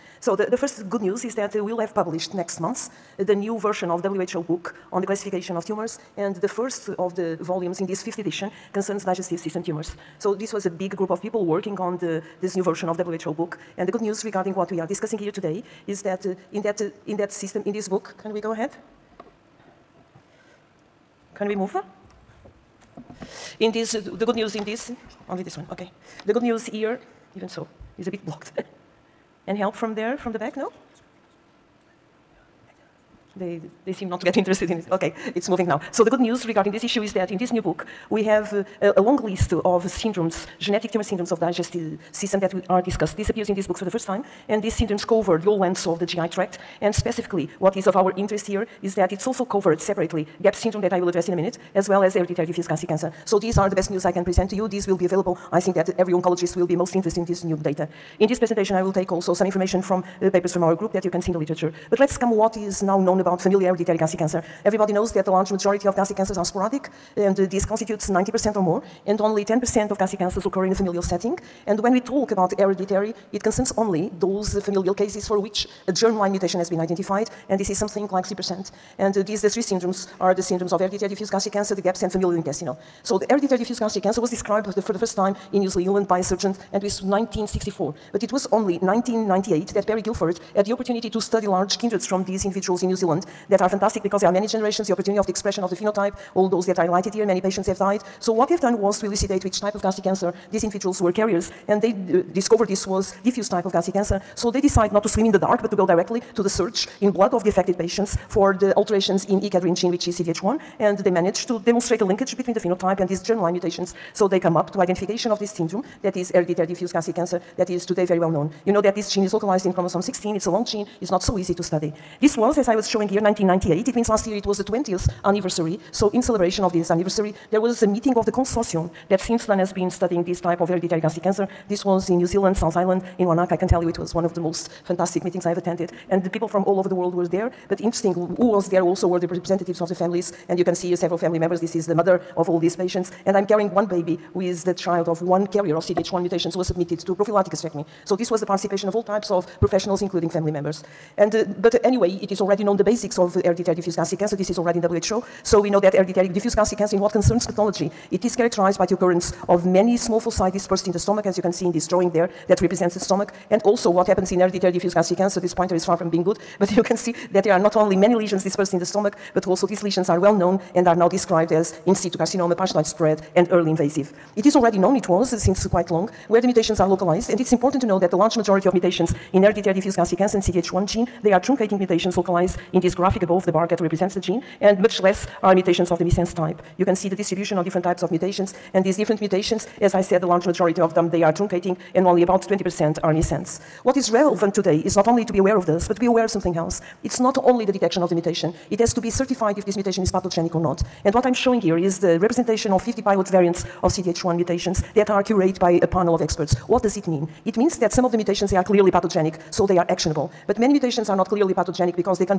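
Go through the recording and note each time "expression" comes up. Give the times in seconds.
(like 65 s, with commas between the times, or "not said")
95 s.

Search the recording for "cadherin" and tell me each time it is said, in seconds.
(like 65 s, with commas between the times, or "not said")
109 s.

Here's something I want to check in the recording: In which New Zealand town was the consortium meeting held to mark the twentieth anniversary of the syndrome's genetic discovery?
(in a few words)
Wanaka.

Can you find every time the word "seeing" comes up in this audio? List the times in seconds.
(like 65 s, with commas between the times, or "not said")
not said.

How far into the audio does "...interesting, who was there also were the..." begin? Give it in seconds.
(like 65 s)
137 s.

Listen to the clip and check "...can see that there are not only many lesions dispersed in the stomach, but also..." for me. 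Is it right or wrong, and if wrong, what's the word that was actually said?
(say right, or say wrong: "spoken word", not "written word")
right.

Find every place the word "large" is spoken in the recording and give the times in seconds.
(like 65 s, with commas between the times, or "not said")
65 s, 91 s, 178 s, 190 s.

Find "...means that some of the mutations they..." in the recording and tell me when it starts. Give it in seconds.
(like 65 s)
207 s.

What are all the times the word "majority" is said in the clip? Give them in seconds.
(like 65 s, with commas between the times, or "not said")
65 s, 178 s, 190 s.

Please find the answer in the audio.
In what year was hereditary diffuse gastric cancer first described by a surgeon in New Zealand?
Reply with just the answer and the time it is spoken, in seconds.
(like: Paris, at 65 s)
1964, at 87 s.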